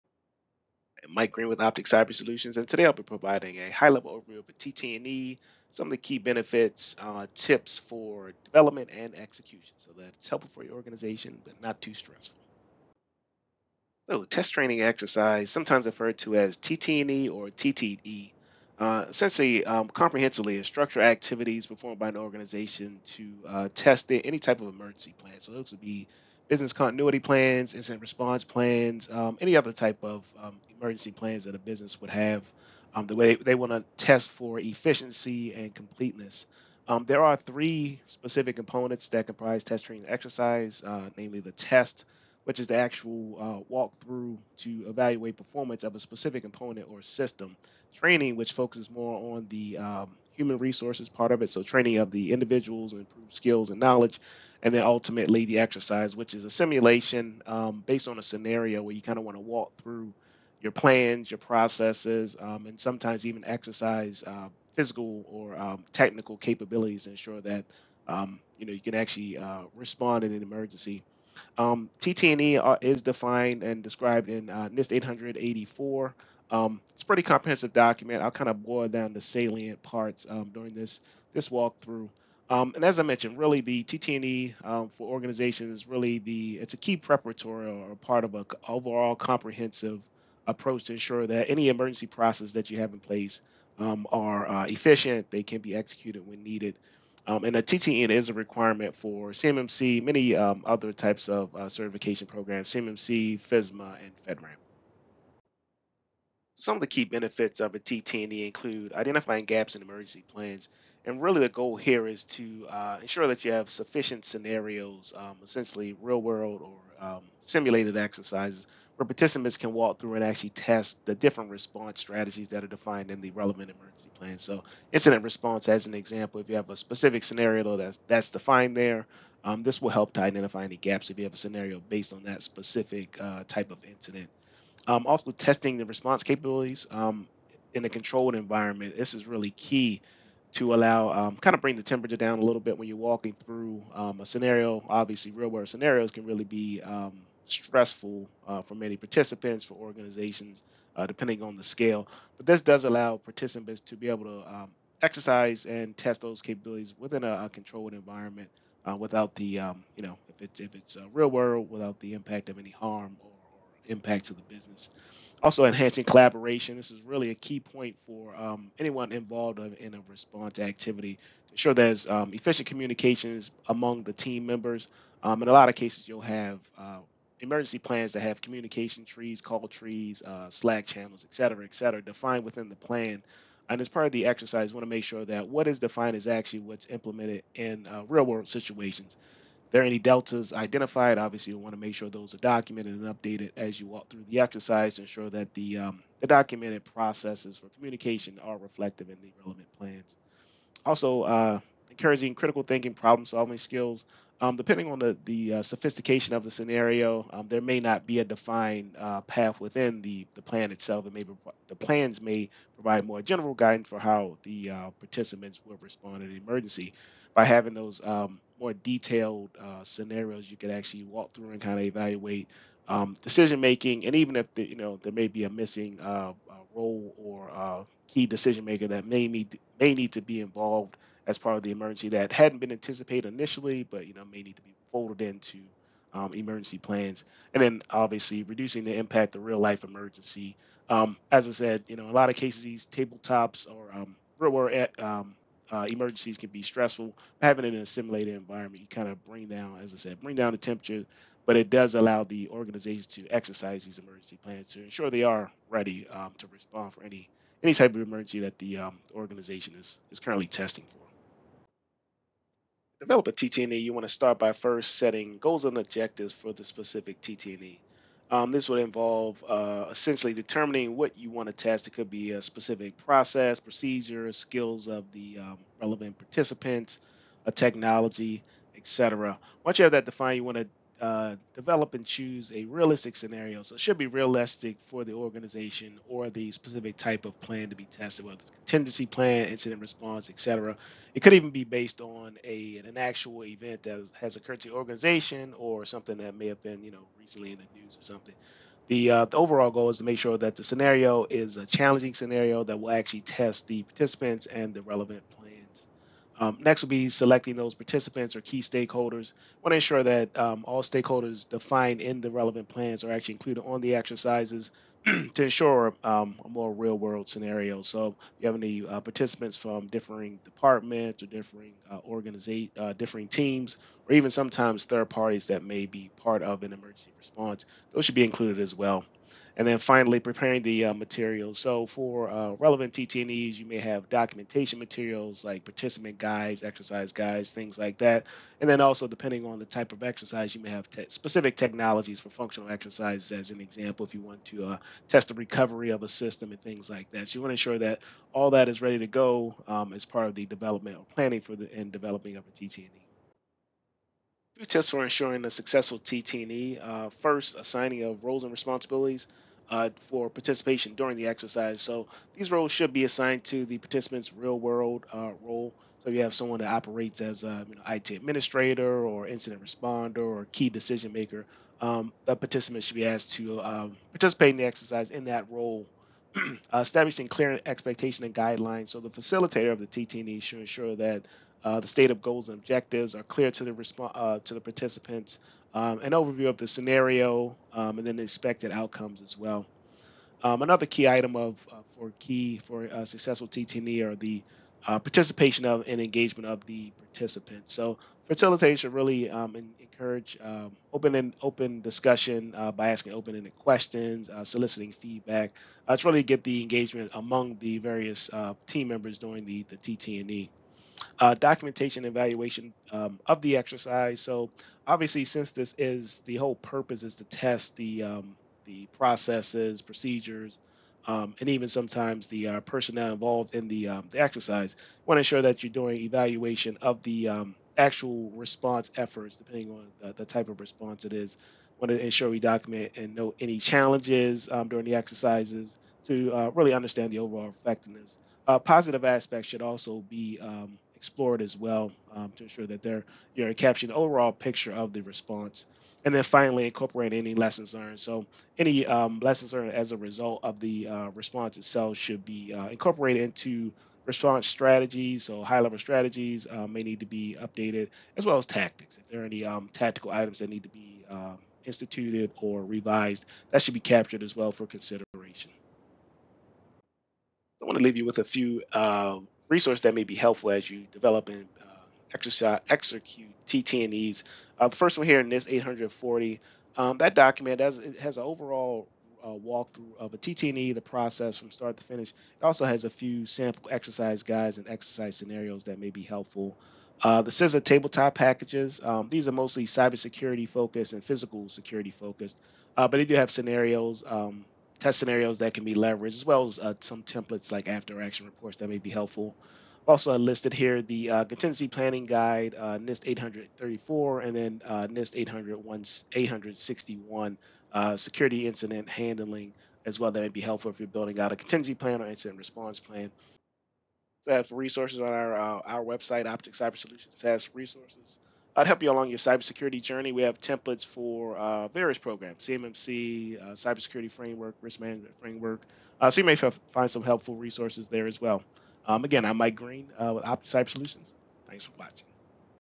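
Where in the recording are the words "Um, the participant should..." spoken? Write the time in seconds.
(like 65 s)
371 s.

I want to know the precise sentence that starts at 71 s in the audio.
Um, TT&E is defined and described in uh, NIST 884.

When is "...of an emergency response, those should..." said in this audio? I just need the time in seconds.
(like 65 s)
326 s.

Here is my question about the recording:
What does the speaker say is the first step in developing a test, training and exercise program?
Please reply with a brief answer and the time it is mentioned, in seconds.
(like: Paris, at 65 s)
Setting goals and objectives, at 264 s.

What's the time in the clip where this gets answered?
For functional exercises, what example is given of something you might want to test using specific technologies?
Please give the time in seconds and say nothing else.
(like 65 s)
345 s.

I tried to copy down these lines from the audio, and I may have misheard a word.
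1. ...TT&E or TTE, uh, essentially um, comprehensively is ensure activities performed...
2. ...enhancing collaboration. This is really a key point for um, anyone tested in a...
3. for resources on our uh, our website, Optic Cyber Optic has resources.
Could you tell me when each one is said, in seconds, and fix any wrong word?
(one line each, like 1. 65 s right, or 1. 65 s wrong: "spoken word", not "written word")
1. 16 s wrong: "structure", not "ensure"
2. 165 s wrong: "involved", not "tested"
3. 514 s wrong: "Solutions", not "Optic".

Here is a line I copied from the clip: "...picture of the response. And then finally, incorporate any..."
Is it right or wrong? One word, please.
right.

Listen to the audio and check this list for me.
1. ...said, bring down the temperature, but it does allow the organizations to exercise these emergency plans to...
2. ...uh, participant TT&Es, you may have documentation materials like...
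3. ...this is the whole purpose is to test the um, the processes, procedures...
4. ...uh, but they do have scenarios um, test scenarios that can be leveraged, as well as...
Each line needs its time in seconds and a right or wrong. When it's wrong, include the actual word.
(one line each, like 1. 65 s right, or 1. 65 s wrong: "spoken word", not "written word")
1. 249 s right
2. 332 s wrong: "relevant", not "participant"
3. 415 s right
4. 492 s right.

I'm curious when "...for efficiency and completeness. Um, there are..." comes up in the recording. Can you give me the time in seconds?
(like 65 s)
34 s.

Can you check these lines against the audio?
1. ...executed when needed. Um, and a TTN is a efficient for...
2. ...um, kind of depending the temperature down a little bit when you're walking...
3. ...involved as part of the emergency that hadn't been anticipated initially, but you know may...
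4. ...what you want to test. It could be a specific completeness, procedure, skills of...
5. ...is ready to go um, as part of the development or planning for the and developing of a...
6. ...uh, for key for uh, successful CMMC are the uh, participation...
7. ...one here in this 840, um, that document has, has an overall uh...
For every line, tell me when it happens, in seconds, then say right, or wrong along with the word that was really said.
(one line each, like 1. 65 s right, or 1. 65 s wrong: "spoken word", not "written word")
1. 95 s wrong: "requirement", not "efficient"
2. 141 s wrong: "bring", not "depending"
3. 230 s right
4. 270 s wrong: "process", not "completeness"
5. 348 s right
6. 391 s wrong: "TTE", not "CMMC"
7. 474 s right.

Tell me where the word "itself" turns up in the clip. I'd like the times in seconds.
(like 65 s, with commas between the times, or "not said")
210 s, 451 s.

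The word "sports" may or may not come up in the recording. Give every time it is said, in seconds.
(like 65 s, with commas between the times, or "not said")
not said.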